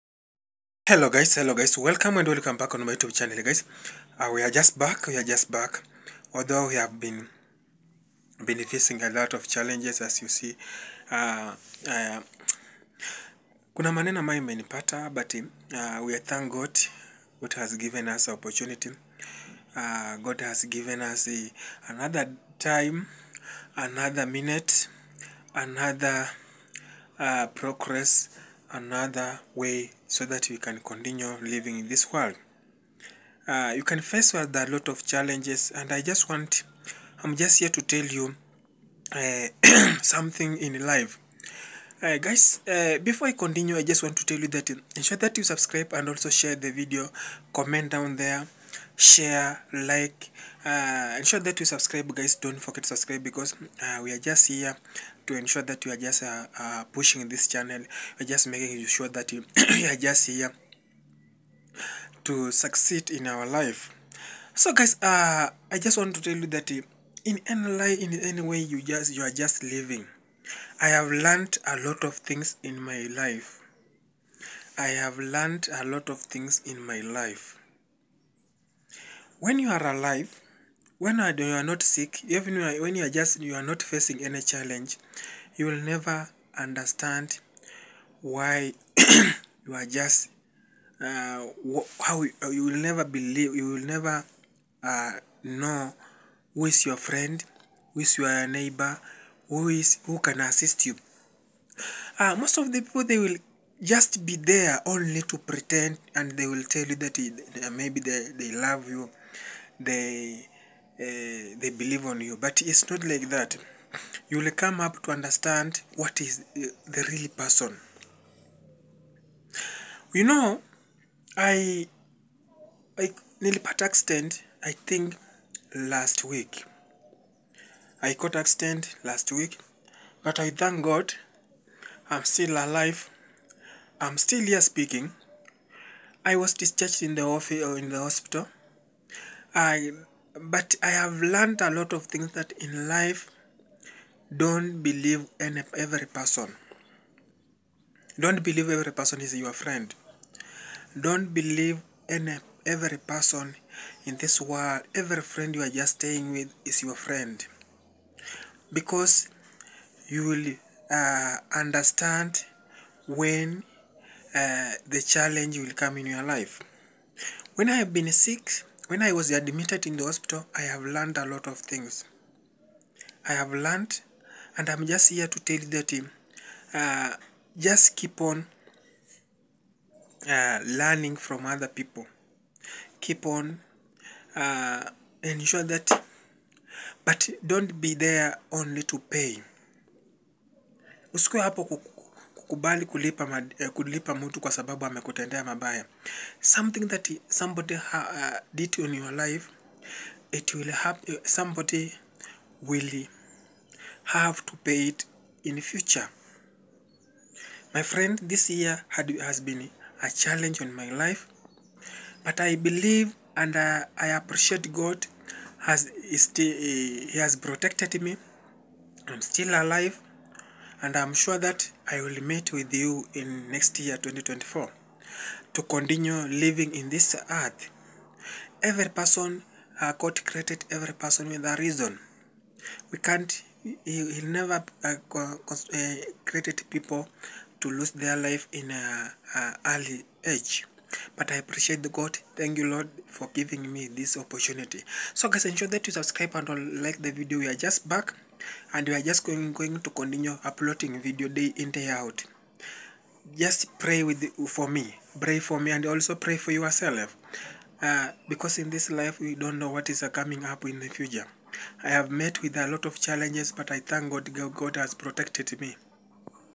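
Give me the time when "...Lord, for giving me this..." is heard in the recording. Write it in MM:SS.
04:02.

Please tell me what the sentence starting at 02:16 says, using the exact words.
I was discharged in the office or uh, in the hospital.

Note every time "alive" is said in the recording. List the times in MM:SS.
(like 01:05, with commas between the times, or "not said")
01:19, 02:12, 03:39.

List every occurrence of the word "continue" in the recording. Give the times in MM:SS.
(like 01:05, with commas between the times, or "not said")
00:30, 00:43, 03:45, 04:09.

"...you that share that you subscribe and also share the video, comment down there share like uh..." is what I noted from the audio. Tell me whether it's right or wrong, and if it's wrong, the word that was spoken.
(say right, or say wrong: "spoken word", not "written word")
wrong: "ensure", not "share".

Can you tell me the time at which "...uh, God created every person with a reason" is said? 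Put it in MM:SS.
03:49.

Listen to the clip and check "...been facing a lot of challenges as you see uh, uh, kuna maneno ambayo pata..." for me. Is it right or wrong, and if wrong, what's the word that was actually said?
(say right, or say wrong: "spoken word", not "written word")
right.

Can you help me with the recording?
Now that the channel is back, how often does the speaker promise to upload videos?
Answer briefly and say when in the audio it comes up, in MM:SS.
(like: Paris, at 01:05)
Day in day out, at 04:11.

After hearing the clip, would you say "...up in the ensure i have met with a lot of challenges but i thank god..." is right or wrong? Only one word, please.
wrong.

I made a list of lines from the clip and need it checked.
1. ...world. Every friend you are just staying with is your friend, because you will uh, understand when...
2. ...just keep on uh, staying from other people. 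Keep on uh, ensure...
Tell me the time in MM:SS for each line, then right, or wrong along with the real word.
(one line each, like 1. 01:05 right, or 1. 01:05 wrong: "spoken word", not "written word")
1. 02:34 right
2. 02:57 wrong: "learning", not "staying".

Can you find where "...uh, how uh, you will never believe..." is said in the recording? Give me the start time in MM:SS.
01:31.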